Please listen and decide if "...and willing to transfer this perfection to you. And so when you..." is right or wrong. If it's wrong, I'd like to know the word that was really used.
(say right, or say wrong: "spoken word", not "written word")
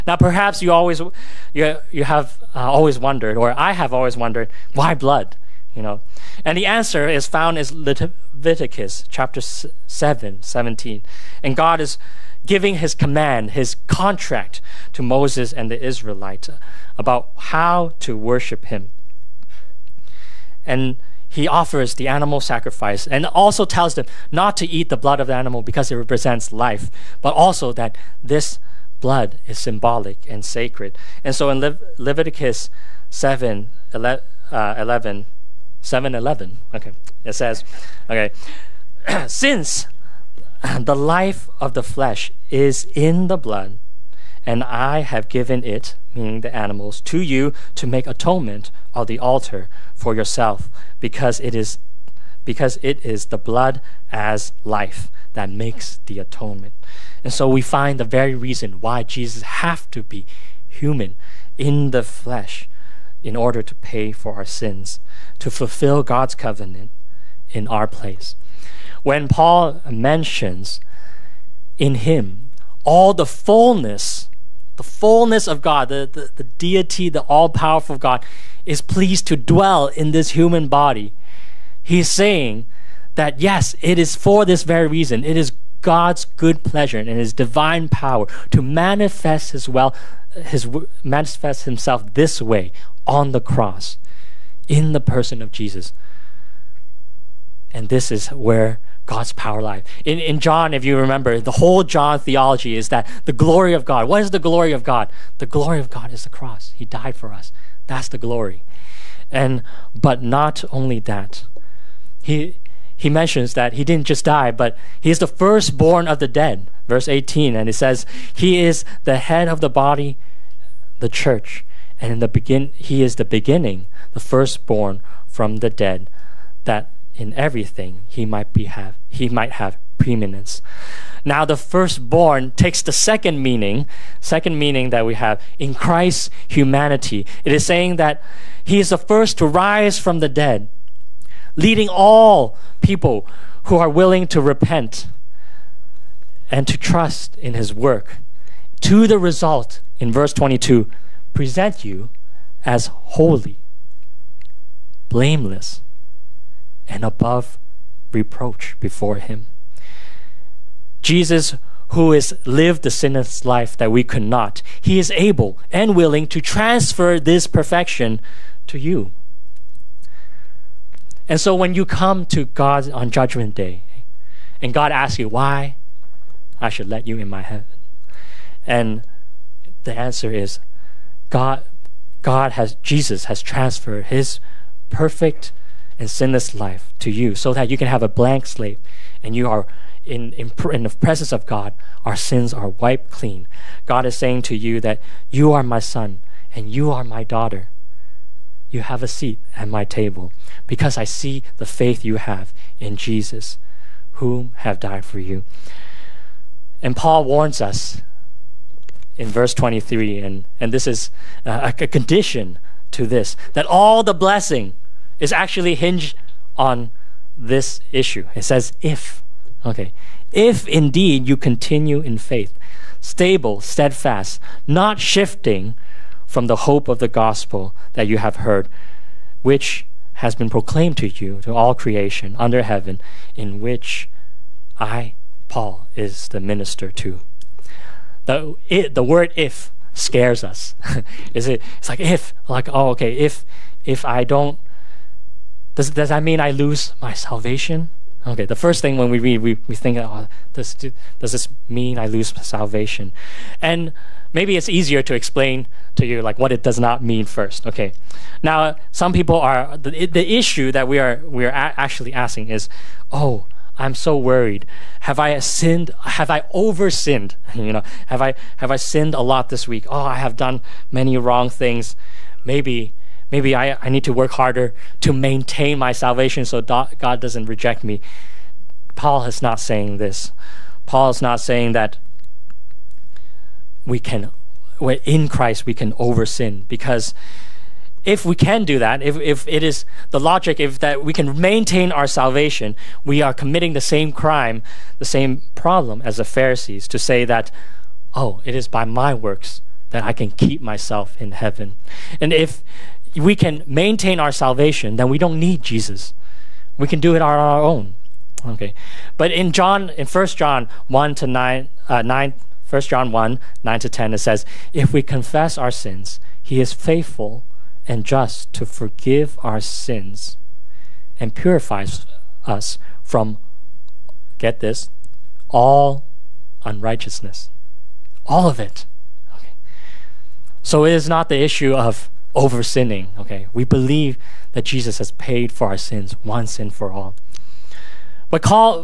right.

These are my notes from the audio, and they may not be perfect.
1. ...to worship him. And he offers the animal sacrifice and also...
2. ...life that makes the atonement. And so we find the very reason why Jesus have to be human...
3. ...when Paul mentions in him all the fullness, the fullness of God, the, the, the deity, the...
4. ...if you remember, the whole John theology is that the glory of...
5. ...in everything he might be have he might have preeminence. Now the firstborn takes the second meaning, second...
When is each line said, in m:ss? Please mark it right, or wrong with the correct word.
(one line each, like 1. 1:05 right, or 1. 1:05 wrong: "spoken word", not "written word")
1. 0:18 right
2. 0:54 right
3. 1:09 right
4. 1:40 right
5. 2:07 right.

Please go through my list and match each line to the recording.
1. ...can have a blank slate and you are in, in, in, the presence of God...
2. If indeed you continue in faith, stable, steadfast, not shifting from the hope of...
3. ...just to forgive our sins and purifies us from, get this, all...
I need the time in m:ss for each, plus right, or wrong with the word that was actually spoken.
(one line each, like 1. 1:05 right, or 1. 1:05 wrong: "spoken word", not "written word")
1. 3:07 right
2. 3:40 right
3. 5:18 right.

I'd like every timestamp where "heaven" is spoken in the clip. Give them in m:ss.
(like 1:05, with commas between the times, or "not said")
2:57, 3:52, 5:01.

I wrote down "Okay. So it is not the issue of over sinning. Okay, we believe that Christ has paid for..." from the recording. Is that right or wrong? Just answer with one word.
wrong.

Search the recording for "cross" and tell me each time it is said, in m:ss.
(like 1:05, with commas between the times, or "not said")
1:33, 1:46.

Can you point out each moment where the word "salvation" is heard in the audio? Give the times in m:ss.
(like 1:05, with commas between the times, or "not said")
4:07, 4:12, 4:35, 4:52, 5:04.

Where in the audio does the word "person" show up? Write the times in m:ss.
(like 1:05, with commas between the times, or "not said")
1:35.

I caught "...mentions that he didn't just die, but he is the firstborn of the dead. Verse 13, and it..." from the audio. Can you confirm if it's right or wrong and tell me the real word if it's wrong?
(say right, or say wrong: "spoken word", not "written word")
wrong: "18", not "13".